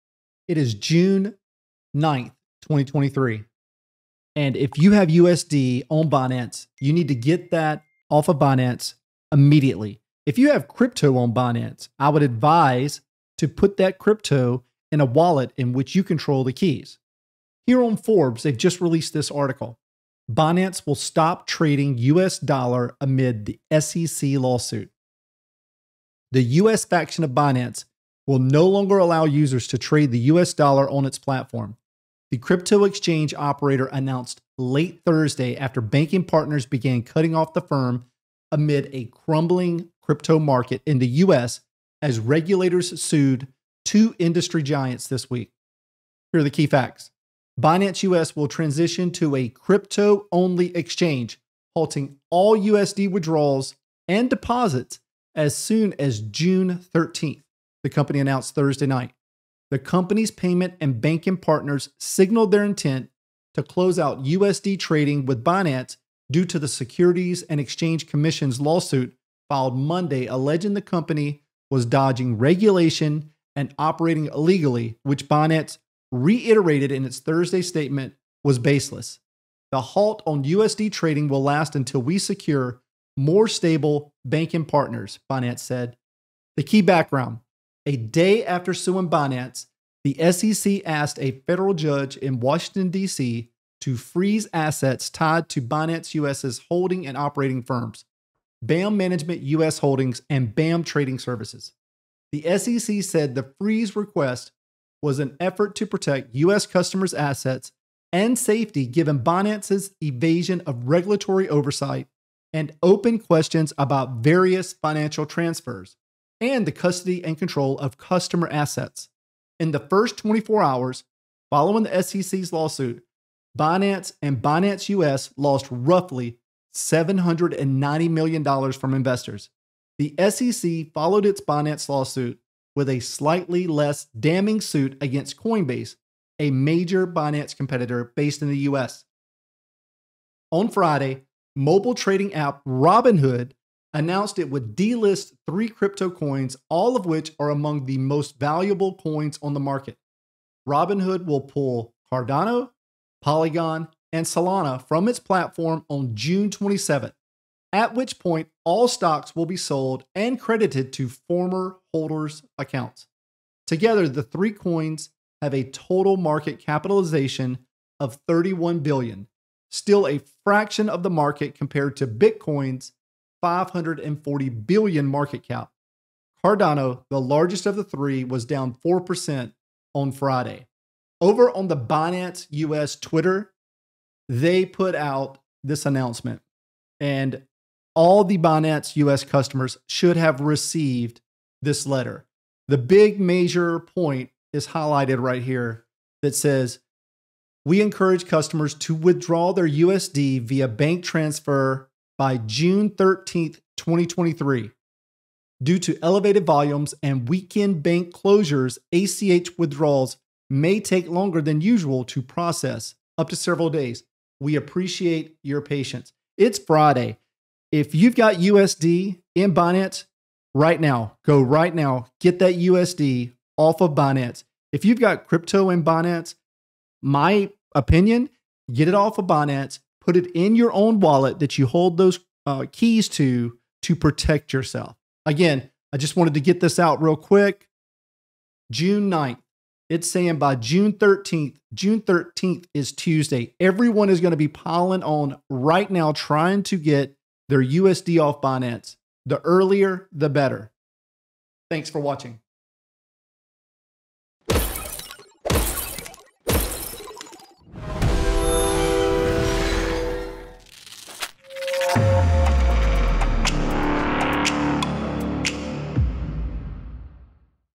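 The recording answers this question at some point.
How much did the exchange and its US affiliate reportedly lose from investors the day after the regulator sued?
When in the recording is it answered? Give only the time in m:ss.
2:06.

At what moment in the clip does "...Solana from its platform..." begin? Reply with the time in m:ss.
2:34.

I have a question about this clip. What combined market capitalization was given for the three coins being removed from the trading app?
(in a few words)
31 billion.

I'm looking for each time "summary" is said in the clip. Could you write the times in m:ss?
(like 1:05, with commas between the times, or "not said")
not said.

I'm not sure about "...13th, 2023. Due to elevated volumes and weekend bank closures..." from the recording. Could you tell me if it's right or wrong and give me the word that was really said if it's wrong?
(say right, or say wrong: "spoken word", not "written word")
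right.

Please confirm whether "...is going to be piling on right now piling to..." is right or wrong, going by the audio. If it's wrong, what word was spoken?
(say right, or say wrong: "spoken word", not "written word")
wrong: "trying", not "piling".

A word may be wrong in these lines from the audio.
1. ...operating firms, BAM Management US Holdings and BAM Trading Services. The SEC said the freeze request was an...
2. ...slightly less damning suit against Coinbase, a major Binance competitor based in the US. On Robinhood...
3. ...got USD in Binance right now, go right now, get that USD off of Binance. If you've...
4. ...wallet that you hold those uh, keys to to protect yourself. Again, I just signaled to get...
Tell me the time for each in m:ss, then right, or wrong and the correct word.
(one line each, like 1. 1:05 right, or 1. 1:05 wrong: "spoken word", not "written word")
1. 1:37 right
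2. 2:13 wrong: "Friday", not "Robinhood"
3. 3:38 right
4. 3:50 wrong: "wanted", not "signaled".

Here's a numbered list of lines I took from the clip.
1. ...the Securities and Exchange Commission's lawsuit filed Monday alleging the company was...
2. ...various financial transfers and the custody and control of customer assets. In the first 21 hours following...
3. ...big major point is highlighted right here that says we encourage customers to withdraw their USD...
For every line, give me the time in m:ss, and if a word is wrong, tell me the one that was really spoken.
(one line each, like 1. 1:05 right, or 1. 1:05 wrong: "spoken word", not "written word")
1. 1:06 right
2. 1:54 wrong: "24", not "21"
3. 3:12 right.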